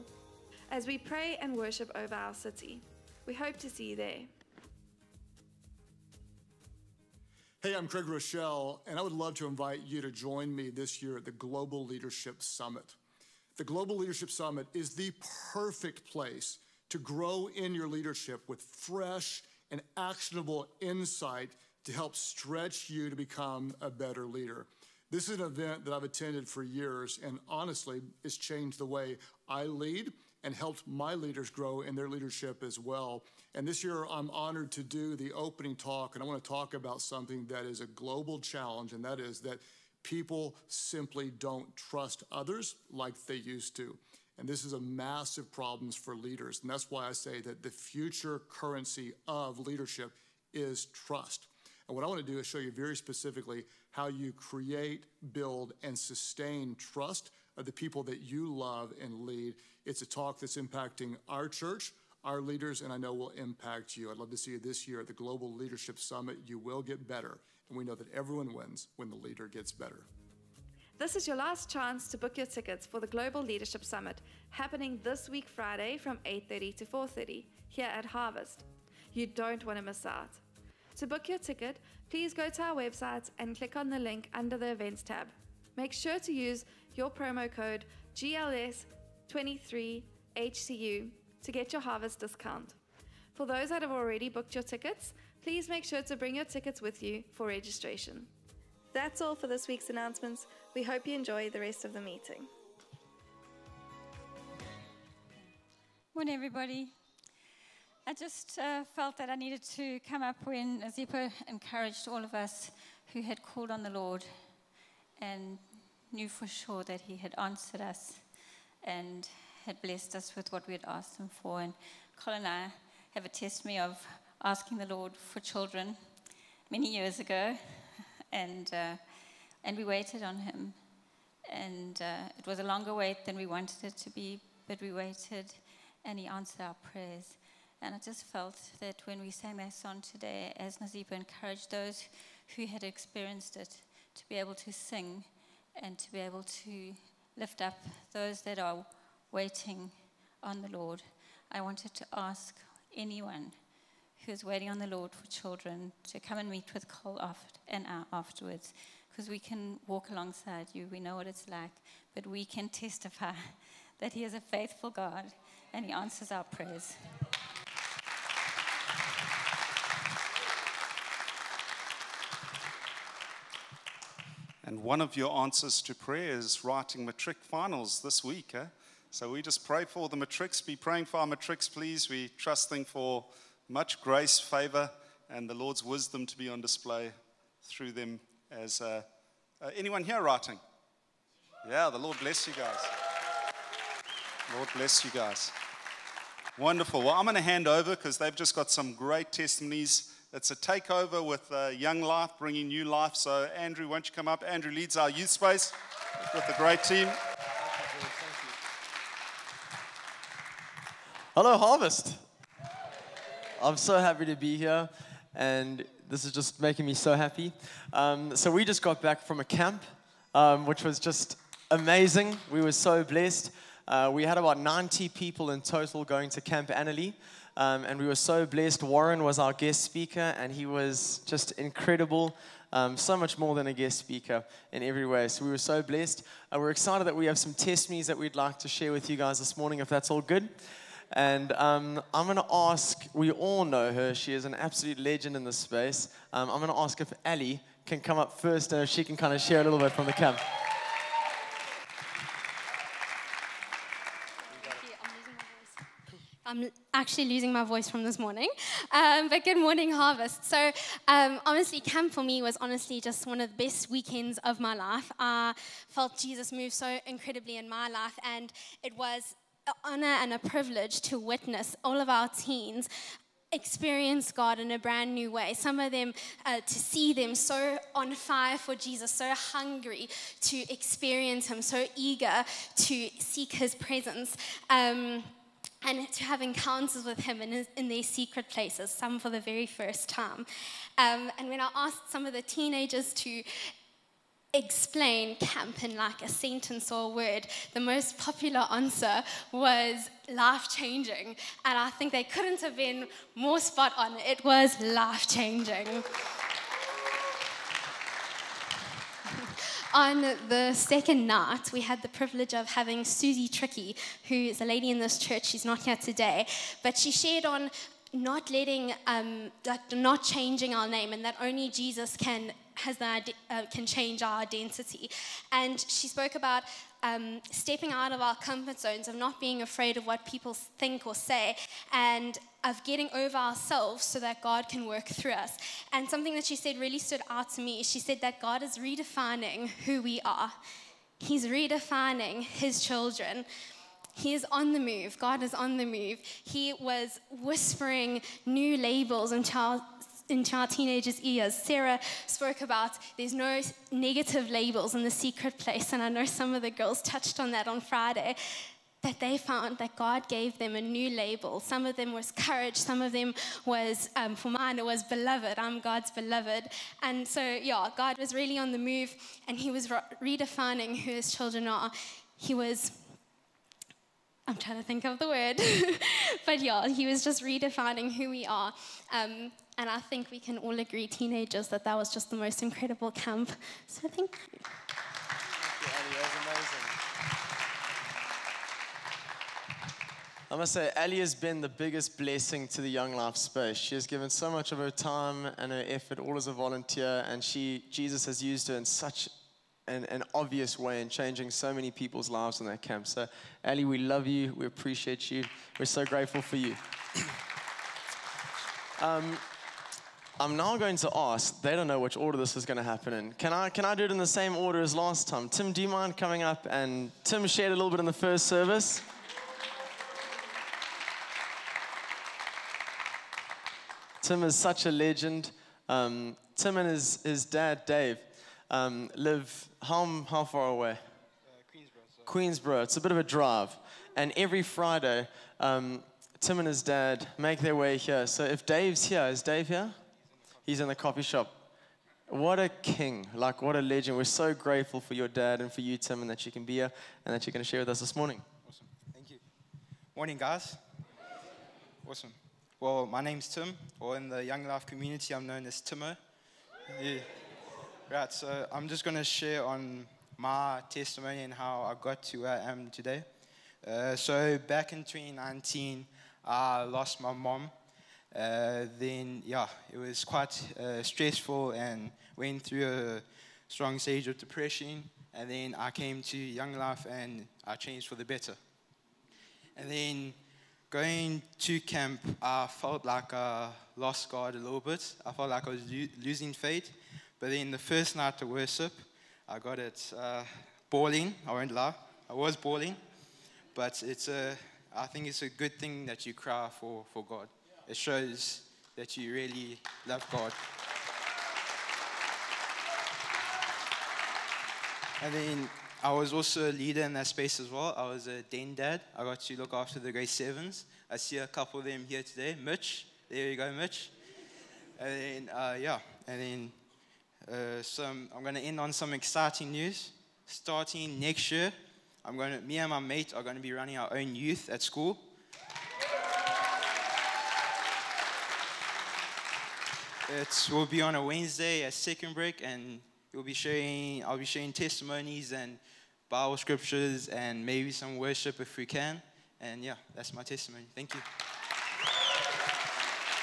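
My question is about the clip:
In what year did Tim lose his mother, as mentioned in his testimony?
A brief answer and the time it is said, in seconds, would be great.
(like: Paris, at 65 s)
2019, at 465 s.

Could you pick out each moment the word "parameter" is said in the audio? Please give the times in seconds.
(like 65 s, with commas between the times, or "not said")
not said.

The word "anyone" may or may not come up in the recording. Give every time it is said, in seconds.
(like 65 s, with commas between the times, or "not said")
152 s, 189 s.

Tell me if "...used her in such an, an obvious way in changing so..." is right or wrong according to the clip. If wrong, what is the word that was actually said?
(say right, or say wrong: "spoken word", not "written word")
right.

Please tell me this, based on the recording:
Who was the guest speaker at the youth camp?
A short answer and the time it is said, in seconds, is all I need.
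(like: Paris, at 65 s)
Warren, at 228 s.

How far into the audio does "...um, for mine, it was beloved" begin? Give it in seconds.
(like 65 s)
364 s.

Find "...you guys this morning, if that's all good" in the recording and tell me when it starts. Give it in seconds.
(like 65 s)
239 s.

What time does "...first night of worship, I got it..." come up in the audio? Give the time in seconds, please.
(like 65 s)
487 s.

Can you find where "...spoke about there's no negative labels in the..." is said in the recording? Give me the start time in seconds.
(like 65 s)
352 s.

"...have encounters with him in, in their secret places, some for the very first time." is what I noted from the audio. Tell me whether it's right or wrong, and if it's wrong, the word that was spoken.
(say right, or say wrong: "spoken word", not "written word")
right.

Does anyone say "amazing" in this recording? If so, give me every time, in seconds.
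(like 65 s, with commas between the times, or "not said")
221 s, 390 s.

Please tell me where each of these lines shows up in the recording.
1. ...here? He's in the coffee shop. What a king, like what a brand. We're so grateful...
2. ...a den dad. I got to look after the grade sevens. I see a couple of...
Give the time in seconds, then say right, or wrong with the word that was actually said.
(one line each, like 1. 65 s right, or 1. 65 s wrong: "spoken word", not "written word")
1. 439 s wrong: "legend", not "brand"
2. 508 s right.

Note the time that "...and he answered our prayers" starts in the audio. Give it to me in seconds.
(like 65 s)
136 s.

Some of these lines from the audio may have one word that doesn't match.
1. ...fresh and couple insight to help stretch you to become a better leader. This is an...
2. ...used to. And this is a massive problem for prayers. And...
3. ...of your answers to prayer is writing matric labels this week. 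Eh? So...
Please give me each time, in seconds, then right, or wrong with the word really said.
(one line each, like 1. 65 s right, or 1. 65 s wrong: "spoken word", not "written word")
1. 18 s wrong: "actionable", not "couple"
2. 43 s wrong: "leaders", not "prayers"
3. 175 s wrong: "finals", not "labels".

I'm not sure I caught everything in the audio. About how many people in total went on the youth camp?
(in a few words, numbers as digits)
90.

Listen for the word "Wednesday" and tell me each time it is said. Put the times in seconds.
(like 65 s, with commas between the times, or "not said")
531 s.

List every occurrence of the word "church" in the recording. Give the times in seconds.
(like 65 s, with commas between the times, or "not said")
61 s, 315 s.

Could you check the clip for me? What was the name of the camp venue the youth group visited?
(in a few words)
Camp Annalee.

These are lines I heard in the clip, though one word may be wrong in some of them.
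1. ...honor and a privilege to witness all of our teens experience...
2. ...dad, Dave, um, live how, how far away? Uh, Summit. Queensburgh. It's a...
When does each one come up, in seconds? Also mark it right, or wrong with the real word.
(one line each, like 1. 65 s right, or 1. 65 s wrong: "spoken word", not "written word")
1. 269 s right
2. 427 s wrong: "Queensburgh", not "Summit".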